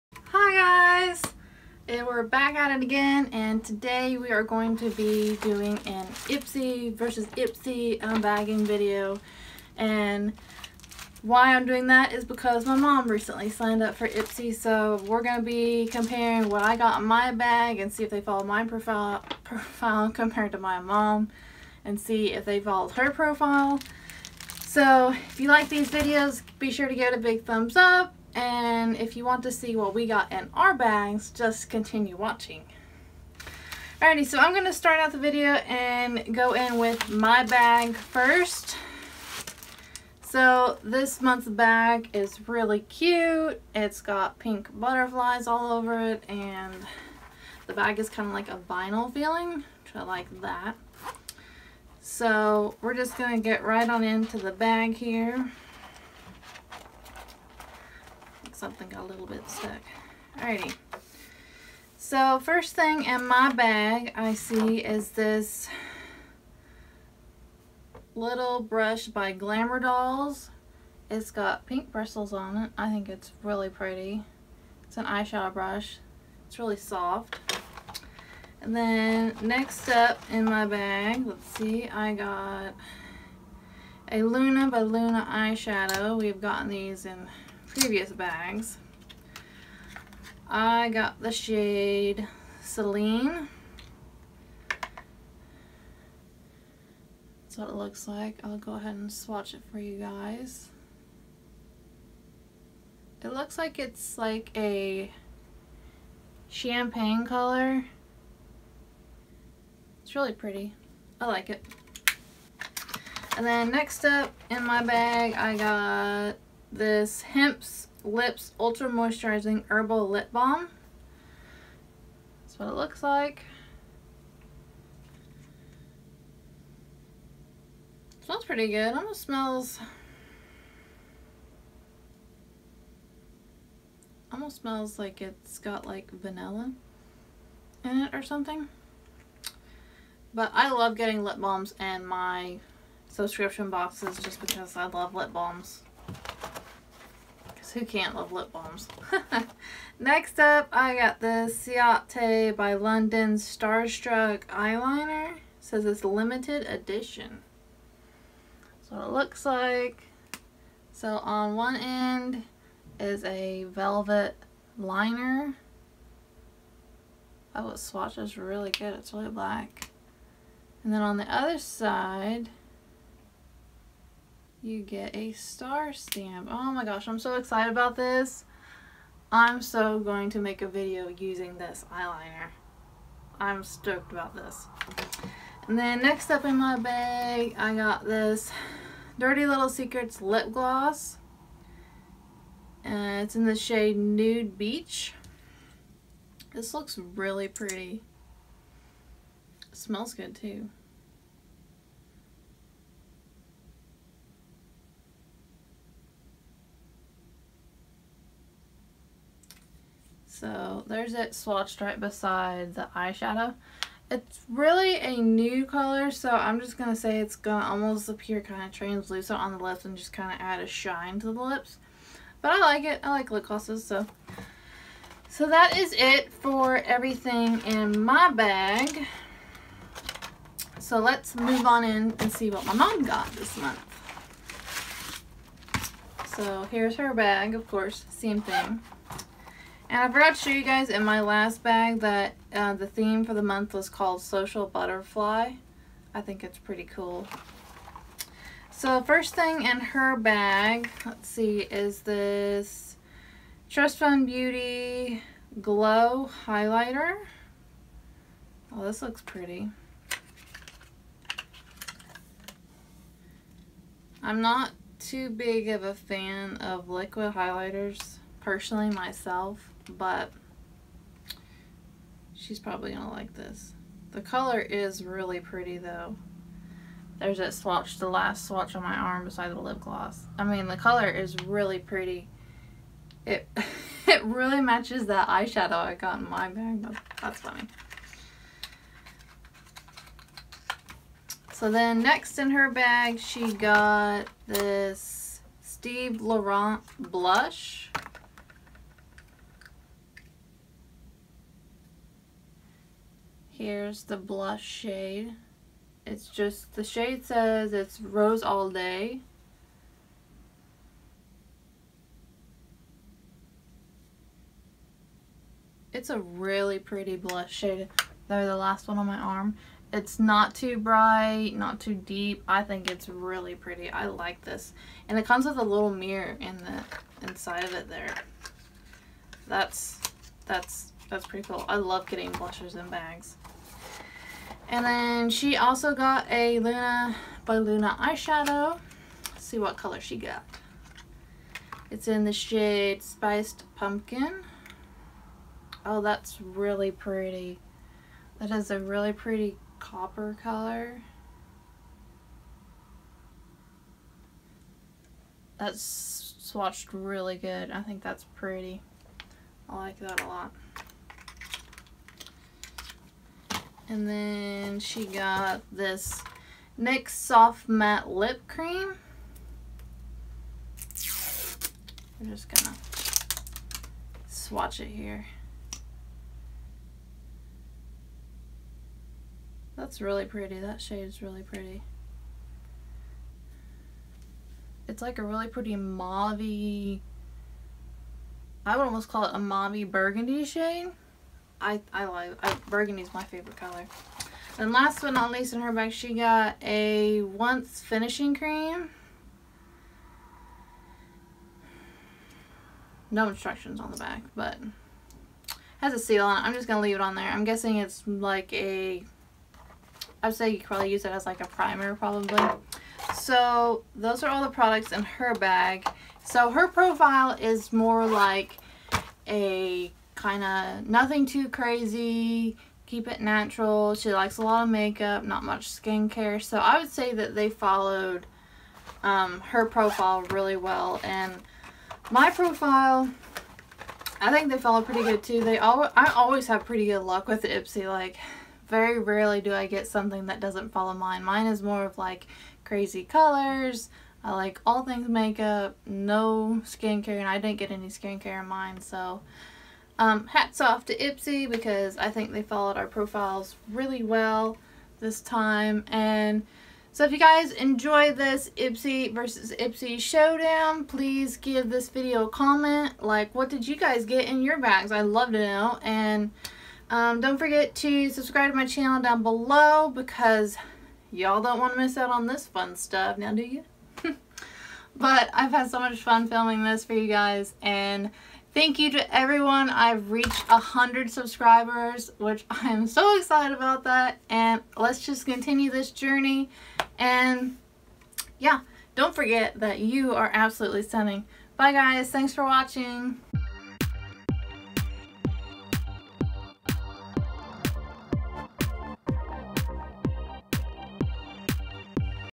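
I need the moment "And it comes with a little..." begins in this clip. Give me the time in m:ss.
5:25.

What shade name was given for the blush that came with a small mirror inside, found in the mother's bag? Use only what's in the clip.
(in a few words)
Rose All Day.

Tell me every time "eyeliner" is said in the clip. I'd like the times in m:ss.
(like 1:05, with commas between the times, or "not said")
2:34, 3:01.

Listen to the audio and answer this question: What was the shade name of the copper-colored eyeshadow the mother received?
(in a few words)
Spiced Pumpkin.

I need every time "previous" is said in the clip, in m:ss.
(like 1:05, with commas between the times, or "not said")
1:27.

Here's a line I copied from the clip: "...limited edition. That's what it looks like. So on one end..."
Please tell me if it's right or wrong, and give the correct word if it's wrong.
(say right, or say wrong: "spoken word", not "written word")
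right.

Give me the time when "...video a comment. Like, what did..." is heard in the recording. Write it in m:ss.
7:41.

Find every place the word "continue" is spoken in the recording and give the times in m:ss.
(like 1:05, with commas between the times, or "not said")
0:31, 8:05.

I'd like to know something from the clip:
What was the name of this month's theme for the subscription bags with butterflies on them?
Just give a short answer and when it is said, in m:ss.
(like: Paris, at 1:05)
Social Butterfly, at 4:04.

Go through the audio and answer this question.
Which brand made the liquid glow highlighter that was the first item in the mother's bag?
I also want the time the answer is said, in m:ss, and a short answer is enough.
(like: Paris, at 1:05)
Trust Fund Beauty, at 4:13.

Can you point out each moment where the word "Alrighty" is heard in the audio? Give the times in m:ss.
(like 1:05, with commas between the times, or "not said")
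0:34, 1:00.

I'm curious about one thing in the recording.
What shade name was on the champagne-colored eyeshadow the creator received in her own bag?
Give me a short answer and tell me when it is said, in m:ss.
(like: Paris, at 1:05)
Celine, at 1:32.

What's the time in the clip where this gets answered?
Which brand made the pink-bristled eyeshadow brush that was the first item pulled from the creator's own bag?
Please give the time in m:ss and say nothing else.
1:09.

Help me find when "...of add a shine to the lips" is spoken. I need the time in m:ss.
3:40.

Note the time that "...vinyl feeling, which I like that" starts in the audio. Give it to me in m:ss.
0:48.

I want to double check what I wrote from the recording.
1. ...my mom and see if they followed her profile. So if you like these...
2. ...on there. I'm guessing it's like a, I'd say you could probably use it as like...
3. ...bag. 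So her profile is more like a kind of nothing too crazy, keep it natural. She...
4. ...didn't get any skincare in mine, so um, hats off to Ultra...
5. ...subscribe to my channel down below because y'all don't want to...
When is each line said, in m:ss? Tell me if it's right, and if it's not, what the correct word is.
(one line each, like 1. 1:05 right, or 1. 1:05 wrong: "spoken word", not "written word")
1. 0:20 right
2. 6:47 right
3. 6:55 right
4. 7:27 wrong: "Ipsy", not "Ultra"
5. 7:48 right.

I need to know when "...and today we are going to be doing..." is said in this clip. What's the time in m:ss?
0:03.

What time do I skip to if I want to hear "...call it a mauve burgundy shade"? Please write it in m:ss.
6:29.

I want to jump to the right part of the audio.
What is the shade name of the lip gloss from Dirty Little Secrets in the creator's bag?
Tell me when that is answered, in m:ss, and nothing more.
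3:13.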